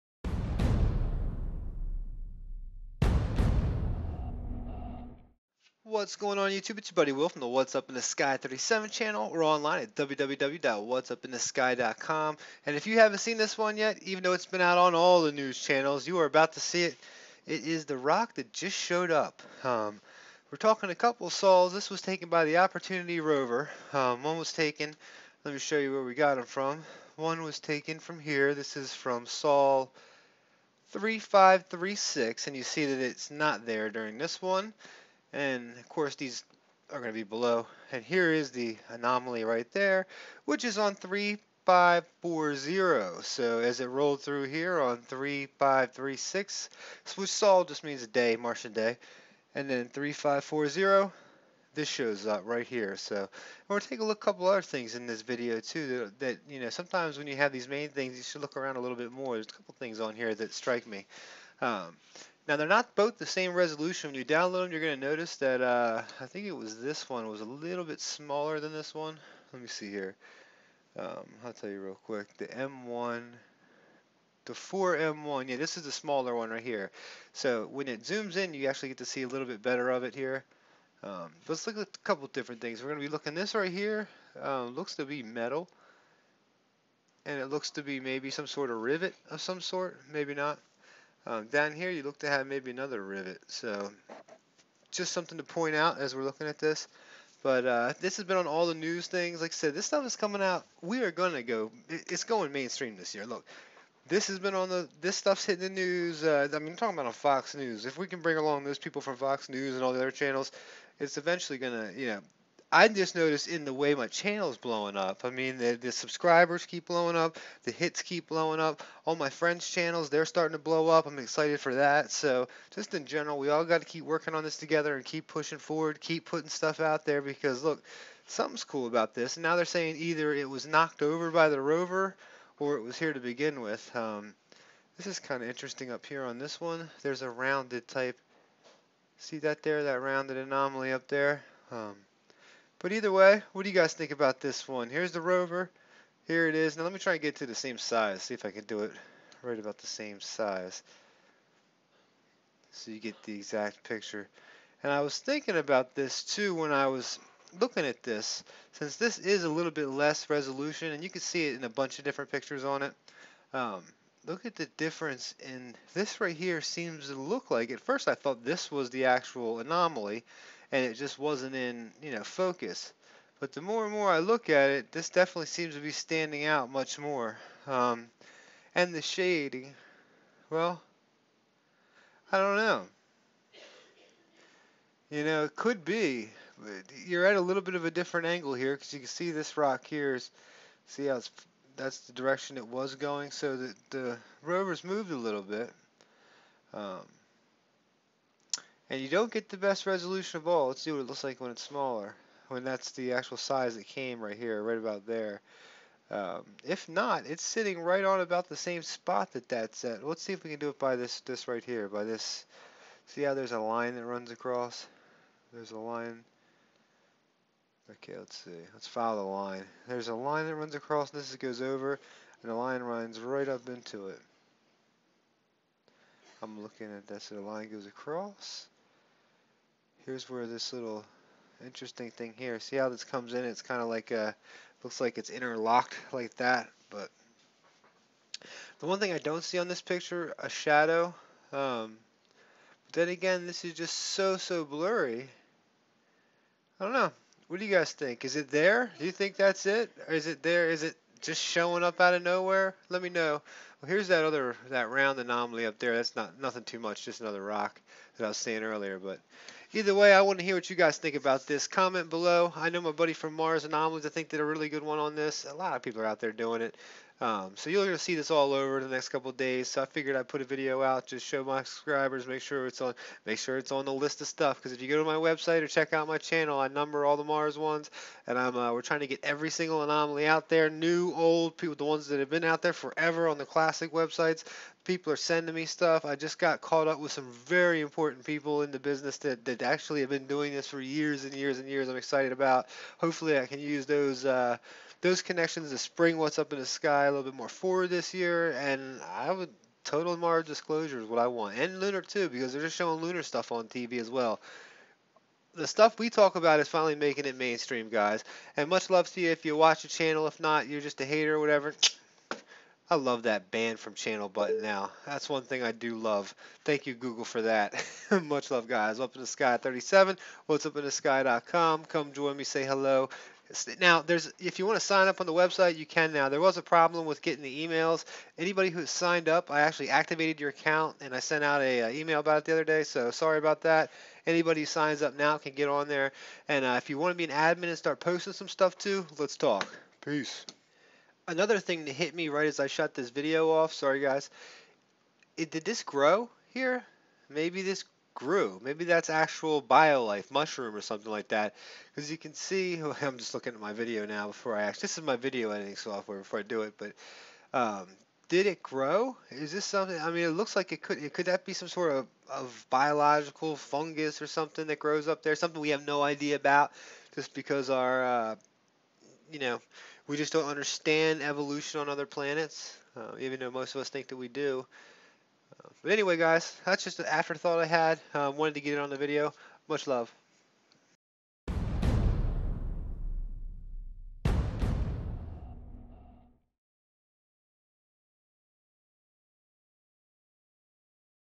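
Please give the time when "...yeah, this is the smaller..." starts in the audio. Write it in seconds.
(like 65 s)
75 s.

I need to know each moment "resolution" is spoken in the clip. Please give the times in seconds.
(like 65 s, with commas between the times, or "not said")
63 s, 160 s, 199 s.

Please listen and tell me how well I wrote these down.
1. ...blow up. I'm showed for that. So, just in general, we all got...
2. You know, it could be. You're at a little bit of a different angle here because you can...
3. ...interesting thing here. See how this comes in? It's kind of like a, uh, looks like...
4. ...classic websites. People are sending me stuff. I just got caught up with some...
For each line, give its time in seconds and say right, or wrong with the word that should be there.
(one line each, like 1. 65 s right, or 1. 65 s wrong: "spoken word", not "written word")
1. 120 s wrong: "excited", not "showed"
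2. 185 s right
3. 231 s right
4. 283 s right.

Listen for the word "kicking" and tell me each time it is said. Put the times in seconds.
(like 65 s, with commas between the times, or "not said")
not said.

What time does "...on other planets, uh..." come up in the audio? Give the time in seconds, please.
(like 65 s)
371 s.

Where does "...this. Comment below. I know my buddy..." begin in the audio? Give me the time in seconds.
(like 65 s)
261 s.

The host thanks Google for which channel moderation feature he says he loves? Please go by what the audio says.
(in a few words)
ban from channel button.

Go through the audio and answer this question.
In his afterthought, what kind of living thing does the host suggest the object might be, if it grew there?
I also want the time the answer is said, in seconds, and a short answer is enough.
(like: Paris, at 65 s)
mushroom, at 350 s.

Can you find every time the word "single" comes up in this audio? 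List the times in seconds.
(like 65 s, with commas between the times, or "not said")
279 s.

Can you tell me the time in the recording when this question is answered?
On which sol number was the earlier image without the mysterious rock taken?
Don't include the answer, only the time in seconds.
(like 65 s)
29 s.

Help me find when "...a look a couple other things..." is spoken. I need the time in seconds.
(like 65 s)
54 s.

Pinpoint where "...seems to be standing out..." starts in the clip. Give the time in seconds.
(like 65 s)
175 s.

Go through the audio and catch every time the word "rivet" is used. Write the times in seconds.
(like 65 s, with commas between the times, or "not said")
88 s, 93 s.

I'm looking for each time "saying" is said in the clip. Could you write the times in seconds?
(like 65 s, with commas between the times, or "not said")
129 s, 258 s.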